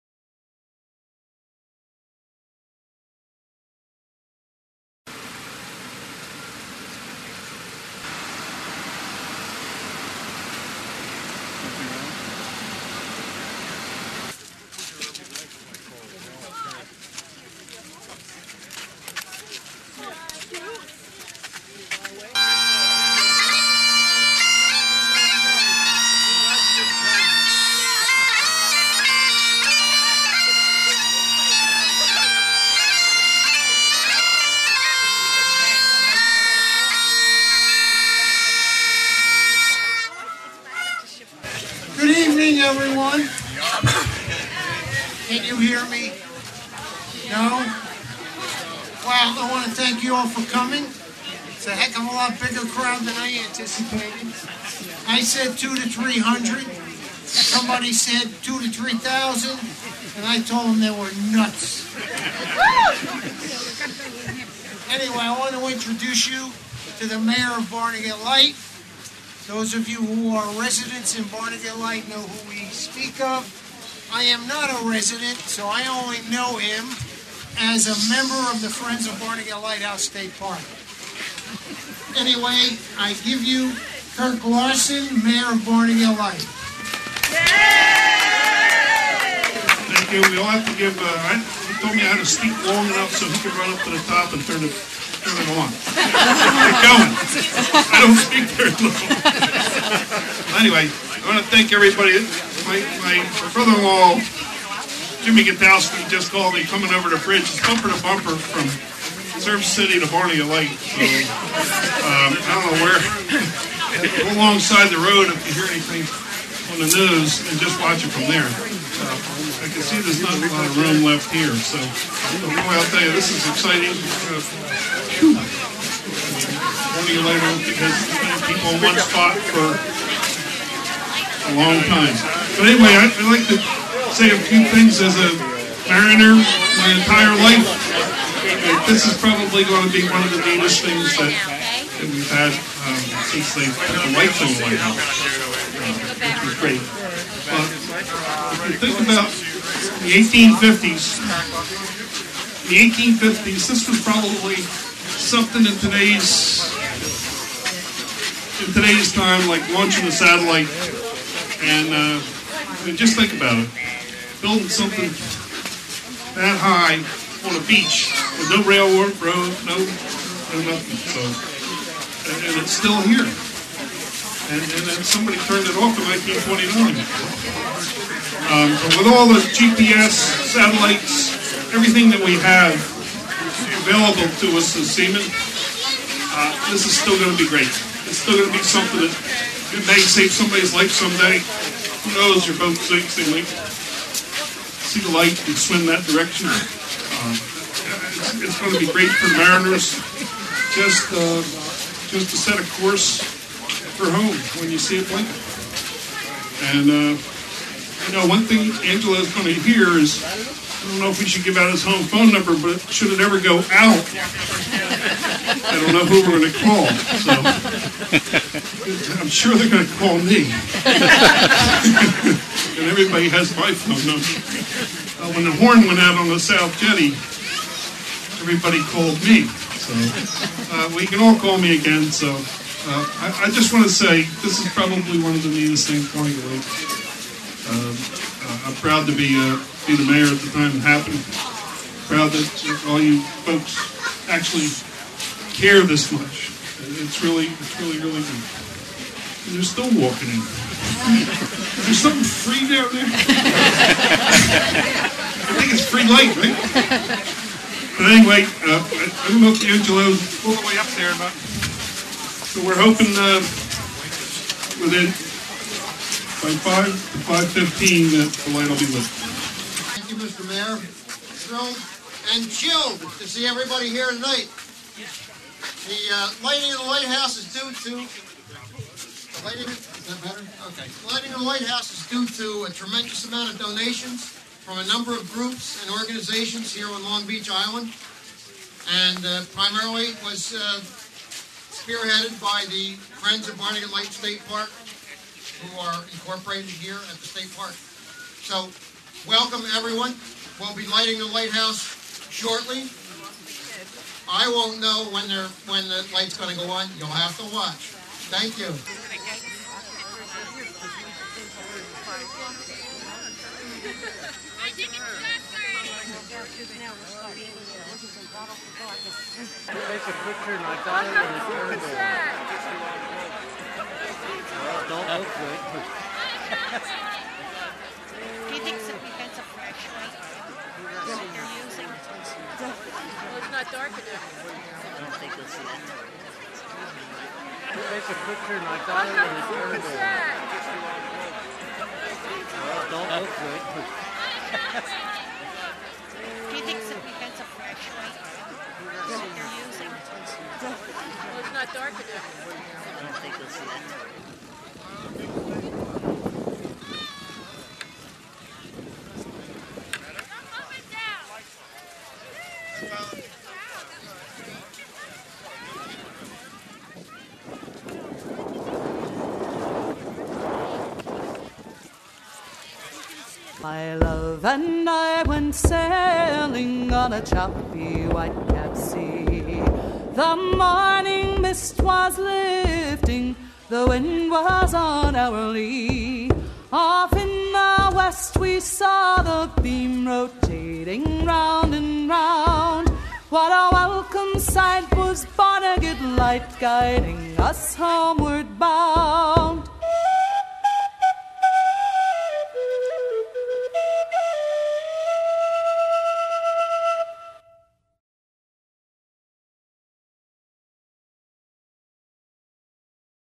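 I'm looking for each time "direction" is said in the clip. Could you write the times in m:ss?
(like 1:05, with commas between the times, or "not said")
3:16.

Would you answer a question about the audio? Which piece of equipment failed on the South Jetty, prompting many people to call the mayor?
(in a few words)
the horn.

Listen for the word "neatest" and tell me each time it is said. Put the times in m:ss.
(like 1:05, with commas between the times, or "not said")
2:20, 3:55.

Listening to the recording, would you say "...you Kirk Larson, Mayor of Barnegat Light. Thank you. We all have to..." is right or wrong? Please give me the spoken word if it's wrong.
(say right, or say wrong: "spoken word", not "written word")
right.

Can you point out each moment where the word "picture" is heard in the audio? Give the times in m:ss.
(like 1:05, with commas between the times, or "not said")
5:18, 5:38.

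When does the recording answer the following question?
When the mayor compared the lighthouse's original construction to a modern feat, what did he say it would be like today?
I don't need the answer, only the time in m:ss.
2:39.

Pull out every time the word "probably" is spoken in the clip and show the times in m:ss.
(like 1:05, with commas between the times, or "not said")
2:19, 2:34, 3:54.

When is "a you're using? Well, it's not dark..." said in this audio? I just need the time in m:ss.
5:28.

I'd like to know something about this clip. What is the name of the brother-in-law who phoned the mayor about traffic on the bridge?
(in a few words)
Jimmy Gatowski.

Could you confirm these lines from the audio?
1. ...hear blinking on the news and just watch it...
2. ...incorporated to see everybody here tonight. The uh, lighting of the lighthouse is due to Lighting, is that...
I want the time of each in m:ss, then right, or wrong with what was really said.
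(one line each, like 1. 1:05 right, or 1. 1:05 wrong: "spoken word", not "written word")
1. 1:55 wrong: "anything", not "blinking"
2. 4:32 wrong: "chilled", not "incorporated".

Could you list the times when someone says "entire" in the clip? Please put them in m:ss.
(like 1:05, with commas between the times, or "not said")
2:17.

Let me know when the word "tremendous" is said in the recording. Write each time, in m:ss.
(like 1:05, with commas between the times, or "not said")
4:42.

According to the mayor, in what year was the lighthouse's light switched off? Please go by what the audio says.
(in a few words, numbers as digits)
1929.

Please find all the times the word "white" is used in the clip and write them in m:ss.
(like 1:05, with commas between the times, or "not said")
2:24, 6:18.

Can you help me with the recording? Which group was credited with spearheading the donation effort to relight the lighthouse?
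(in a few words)
Friends of Barnegat Light State Park.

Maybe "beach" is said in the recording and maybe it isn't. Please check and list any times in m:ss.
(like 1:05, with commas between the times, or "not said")
2:47, 4:47.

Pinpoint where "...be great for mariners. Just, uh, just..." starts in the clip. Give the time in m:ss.
3:18.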